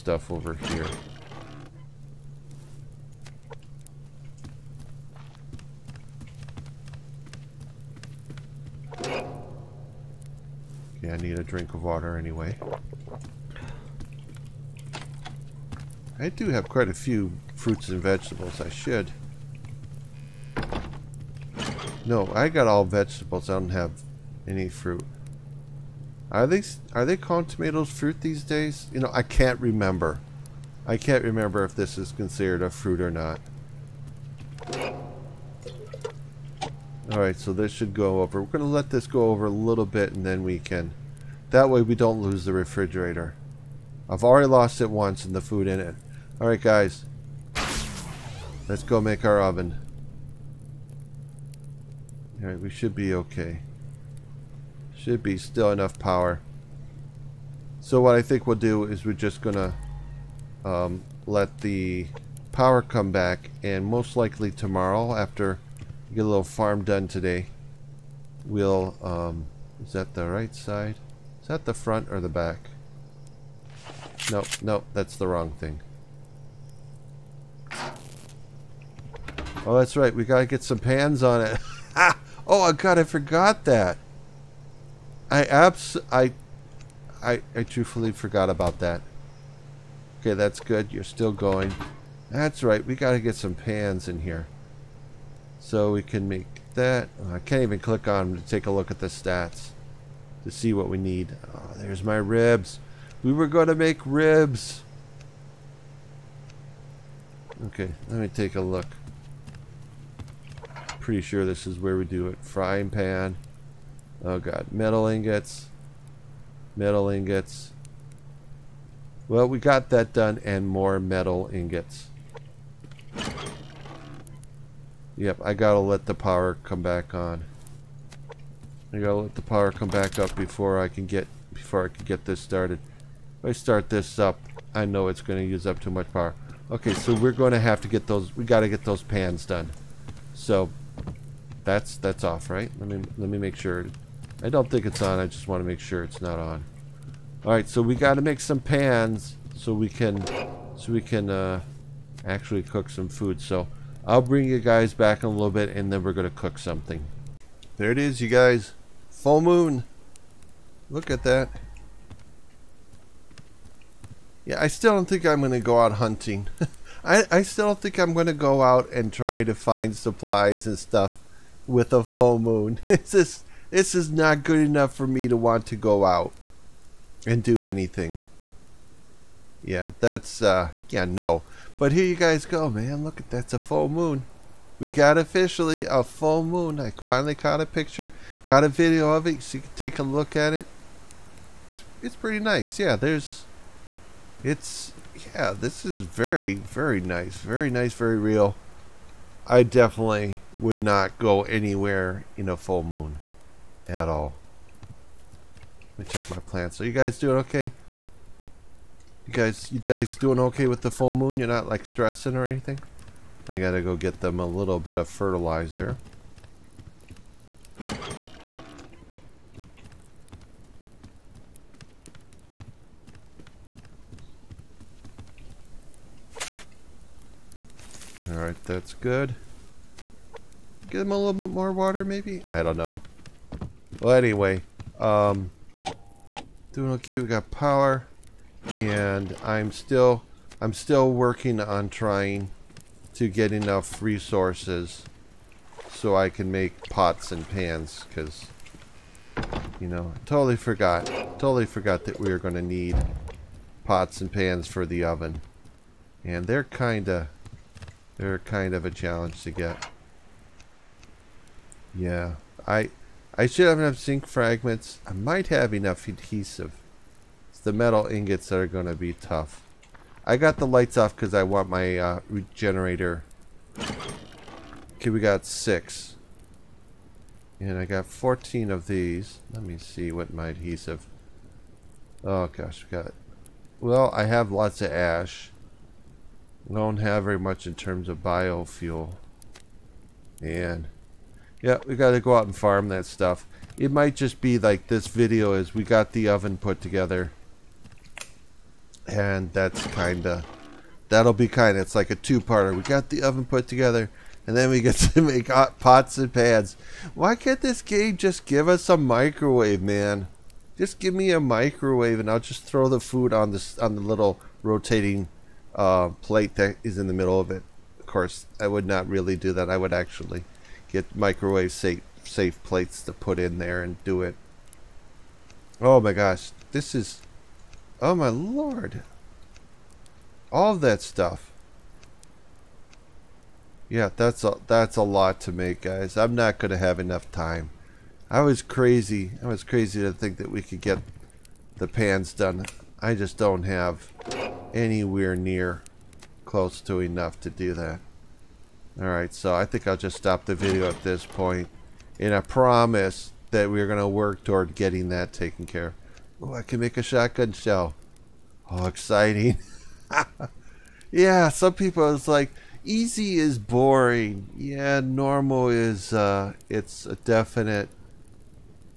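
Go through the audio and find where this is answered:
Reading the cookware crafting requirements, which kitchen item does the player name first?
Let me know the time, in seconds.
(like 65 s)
112 s.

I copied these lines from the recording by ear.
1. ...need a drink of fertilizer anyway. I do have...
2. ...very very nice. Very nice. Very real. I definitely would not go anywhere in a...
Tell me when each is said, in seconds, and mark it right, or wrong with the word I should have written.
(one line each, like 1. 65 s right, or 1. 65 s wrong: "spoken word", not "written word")
1. 11 s wrong: "water", not "fertilizer"
2. 196 s right.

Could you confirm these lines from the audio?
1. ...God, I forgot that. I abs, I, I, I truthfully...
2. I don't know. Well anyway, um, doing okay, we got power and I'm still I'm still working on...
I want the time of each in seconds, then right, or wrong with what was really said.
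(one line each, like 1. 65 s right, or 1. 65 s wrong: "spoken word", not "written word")
1. 82 s right
2. 232 s right.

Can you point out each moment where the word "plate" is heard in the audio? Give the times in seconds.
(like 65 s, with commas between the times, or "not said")
316 s, 322 s.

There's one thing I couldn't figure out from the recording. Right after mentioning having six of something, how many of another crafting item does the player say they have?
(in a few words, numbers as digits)
14.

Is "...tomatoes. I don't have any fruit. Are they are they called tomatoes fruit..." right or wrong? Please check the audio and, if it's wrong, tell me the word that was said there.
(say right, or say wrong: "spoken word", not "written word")
wrong: "vegetables", not "tomatoes".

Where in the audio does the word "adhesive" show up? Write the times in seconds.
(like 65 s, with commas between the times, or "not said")
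266 s, 280 s.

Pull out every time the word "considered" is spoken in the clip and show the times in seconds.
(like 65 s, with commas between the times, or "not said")
32 s.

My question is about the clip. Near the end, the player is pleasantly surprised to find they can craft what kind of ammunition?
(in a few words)
shotgun shell.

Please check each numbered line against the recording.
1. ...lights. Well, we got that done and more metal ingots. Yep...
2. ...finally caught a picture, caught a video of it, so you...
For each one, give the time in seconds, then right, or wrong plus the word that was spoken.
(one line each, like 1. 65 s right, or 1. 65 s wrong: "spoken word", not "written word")
1. 117 s wrong: "ingots", not "lights"
2. 186 s right.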